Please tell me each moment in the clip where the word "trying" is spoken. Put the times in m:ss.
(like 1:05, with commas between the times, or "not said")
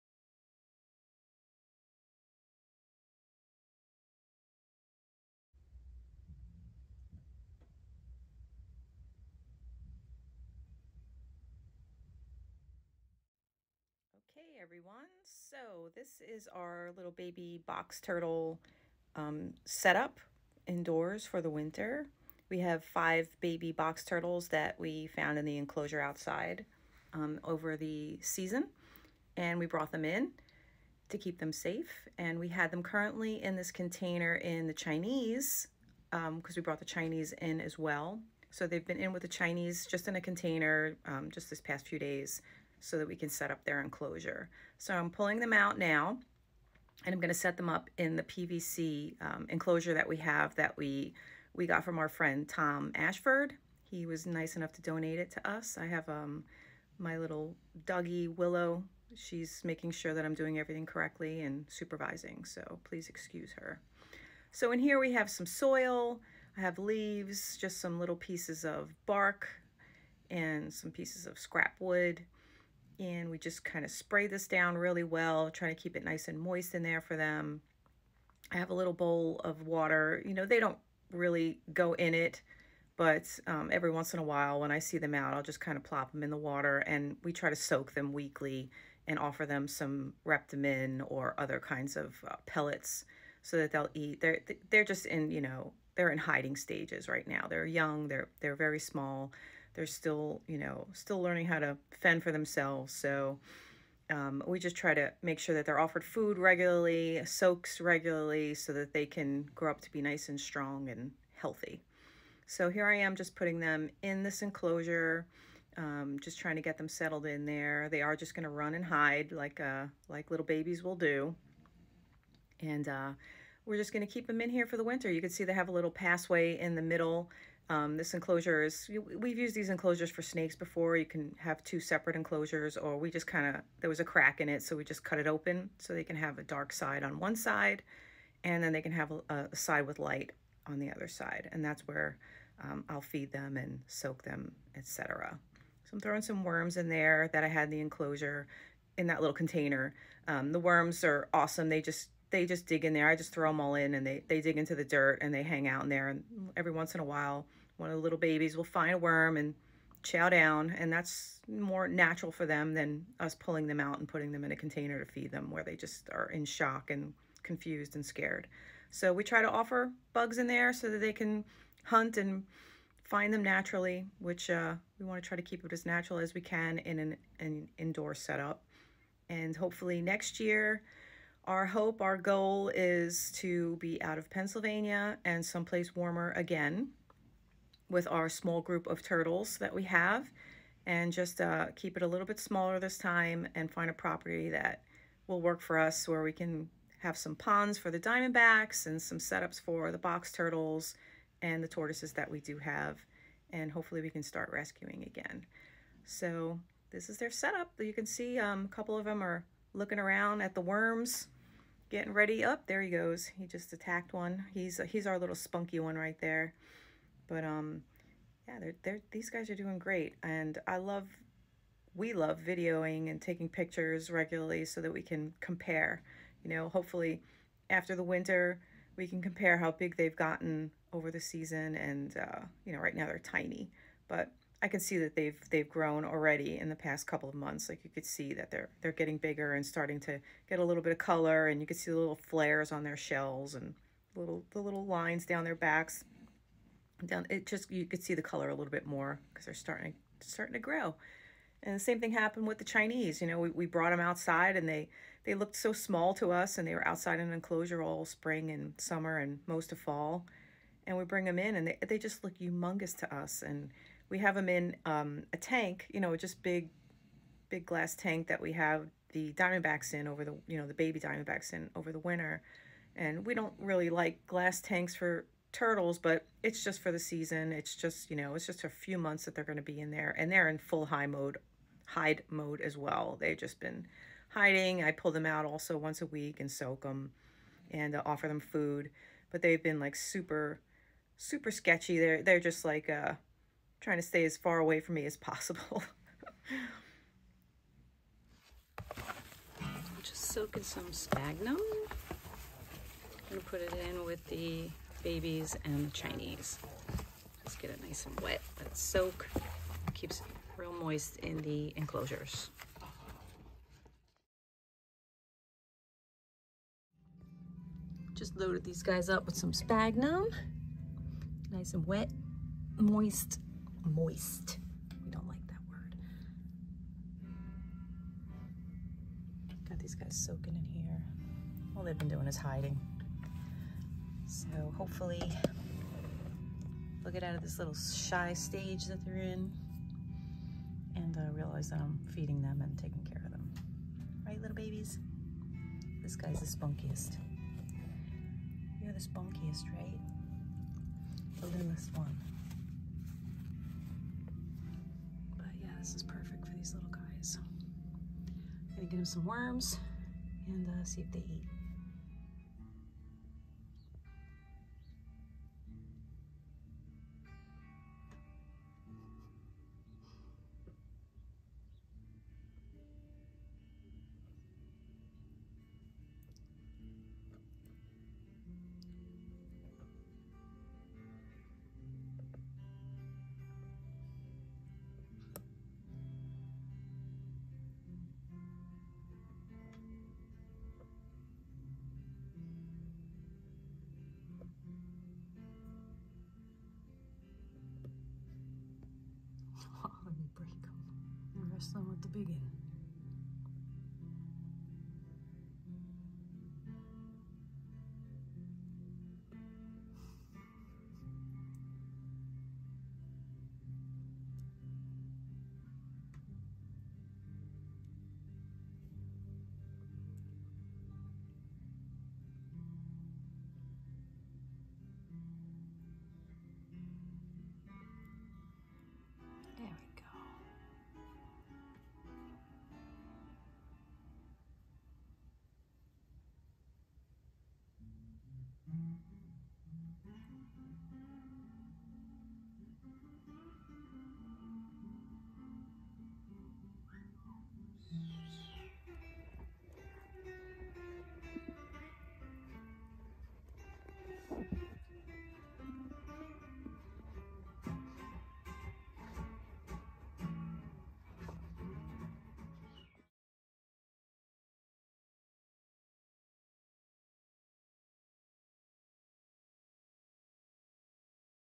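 1:15, 1:56, 4:53.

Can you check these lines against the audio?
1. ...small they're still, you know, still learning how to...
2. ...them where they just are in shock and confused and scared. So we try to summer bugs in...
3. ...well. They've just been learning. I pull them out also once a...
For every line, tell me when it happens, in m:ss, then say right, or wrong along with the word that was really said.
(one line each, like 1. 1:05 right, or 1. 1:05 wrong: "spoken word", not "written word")
1. 1:38 right
2. 2:45 wrong: "offer", not "summer"
3. 4:42 wrong: "hiding", not "learning".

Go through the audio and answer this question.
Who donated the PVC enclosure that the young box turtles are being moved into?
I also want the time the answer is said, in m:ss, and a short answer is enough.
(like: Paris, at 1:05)
Tom Ashford, at 0:52.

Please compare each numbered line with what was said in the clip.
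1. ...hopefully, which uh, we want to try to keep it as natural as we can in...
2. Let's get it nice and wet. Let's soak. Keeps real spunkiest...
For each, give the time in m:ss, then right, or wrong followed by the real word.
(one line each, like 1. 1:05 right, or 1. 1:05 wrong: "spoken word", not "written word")
1. 2:53 wrong: "naturally", not "hopefully"
2. 5:07 wrong: "moist", not "spunkiest".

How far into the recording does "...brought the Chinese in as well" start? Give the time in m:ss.
0:36.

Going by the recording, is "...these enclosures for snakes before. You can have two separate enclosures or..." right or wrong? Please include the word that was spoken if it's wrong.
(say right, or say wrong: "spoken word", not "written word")
right.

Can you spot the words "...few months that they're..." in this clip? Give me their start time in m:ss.
4:38.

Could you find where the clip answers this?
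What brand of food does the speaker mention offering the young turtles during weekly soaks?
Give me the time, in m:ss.
1:30.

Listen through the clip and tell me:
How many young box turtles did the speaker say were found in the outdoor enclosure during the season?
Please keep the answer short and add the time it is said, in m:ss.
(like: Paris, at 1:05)
5, at 0:22.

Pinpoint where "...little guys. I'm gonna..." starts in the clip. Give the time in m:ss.
5:56.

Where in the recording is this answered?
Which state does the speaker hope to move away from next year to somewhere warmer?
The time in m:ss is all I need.
3:04.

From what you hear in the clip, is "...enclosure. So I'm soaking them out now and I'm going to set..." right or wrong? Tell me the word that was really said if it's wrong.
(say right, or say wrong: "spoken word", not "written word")
wrong: "pulling", not "soaking".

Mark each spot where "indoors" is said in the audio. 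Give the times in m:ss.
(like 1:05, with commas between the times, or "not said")
0:20, 2:57.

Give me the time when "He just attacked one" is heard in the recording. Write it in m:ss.
3:33.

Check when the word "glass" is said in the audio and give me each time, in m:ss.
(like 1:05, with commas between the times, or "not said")
4:27, 4:34.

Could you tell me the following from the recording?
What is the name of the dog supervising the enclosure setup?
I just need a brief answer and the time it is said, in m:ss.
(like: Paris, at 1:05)
Willow, at 0:58.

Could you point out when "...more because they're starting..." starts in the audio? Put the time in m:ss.
4:08.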